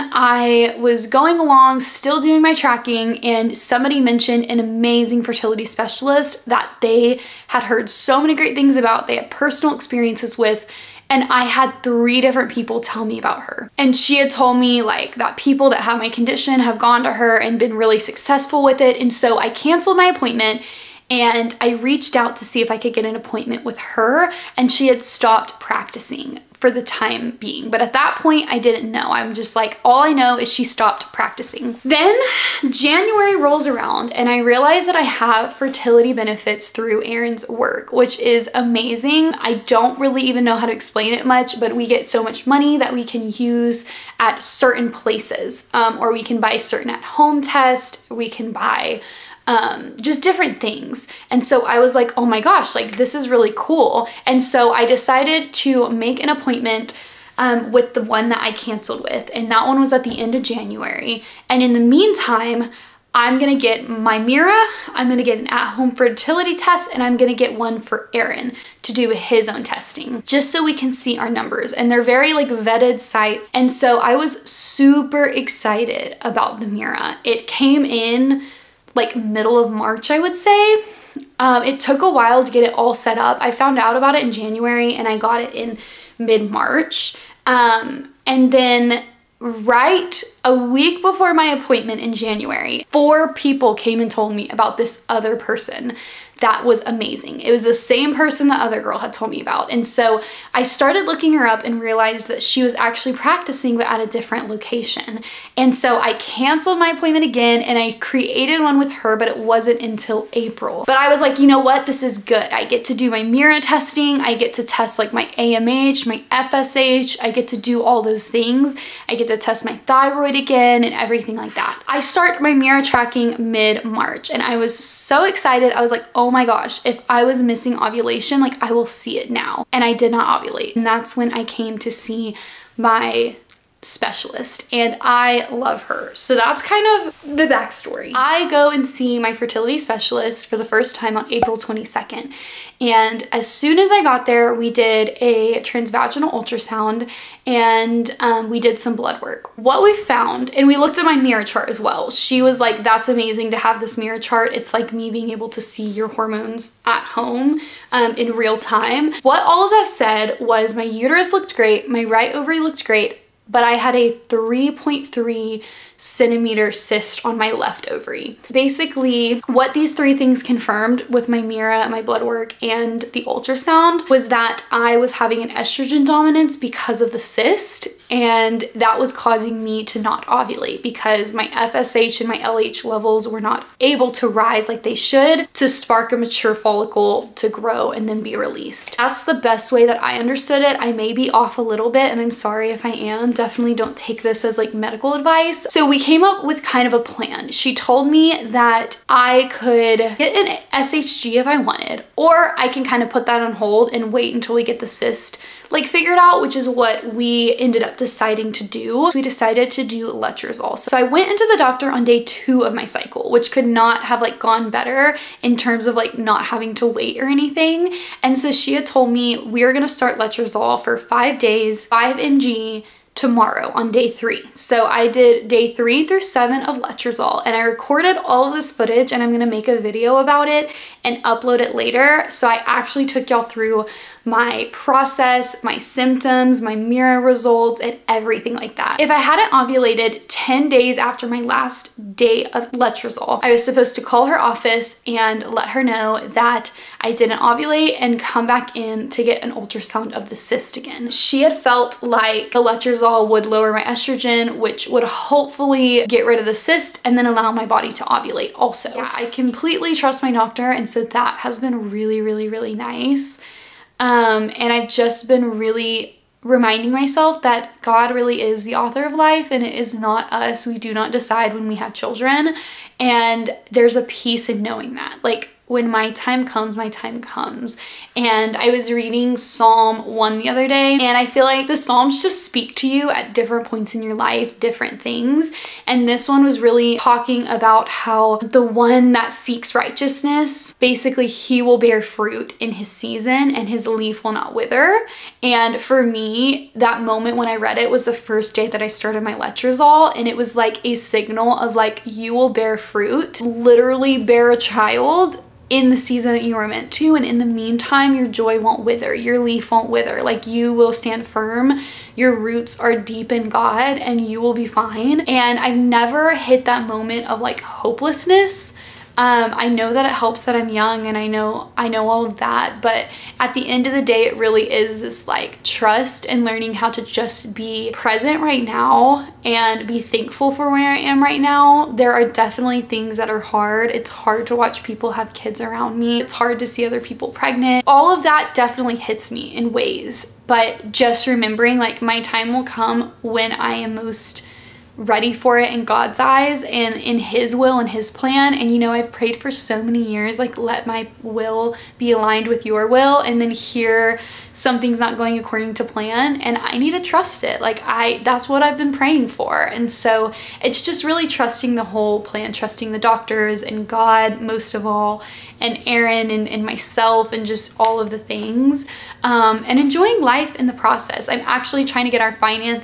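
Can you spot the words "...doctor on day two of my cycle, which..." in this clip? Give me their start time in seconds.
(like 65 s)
211 s.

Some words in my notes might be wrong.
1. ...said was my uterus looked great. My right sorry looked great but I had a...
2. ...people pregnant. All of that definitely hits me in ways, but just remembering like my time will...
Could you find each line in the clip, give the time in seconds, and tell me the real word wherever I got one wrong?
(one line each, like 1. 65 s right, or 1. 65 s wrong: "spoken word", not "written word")
1. 159 s wrong: "ovary", not "sorry"
2. 336 s right.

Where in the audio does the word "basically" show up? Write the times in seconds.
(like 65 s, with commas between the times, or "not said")
168 s, 290 s.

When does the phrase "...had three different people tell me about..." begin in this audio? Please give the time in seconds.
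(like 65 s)
11 s.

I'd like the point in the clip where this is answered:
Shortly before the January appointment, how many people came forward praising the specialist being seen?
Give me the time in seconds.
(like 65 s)
92 s.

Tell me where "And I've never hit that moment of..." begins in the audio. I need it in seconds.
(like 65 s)
315 s.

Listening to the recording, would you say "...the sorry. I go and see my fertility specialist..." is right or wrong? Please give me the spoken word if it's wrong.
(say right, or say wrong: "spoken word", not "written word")
wrong: "backstory", not "sorry".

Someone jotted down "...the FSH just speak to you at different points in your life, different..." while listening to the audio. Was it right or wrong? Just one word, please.
wrong.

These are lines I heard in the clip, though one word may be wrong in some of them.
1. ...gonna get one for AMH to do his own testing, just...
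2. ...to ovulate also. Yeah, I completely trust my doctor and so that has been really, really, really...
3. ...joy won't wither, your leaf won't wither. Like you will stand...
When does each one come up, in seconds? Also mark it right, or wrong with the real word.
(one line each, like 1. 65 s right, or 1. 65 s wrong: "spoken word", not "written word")
1. 67 s wrong: "Aaron", not "AMH"
2. 257 s right
3. 308 s right.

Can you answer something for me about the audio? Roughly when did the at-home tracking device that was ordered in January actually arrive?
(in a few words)
Middle of March.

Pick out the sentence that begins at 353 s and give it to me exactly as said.
And then here, something's not going according to plan and I need to trust it.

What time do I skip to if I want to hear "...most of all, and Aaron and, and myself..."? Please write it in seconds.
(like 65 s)
364 s.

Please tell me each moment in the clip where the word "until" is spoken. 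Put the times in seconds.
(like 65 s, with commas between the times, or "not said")
109 s, 204 s.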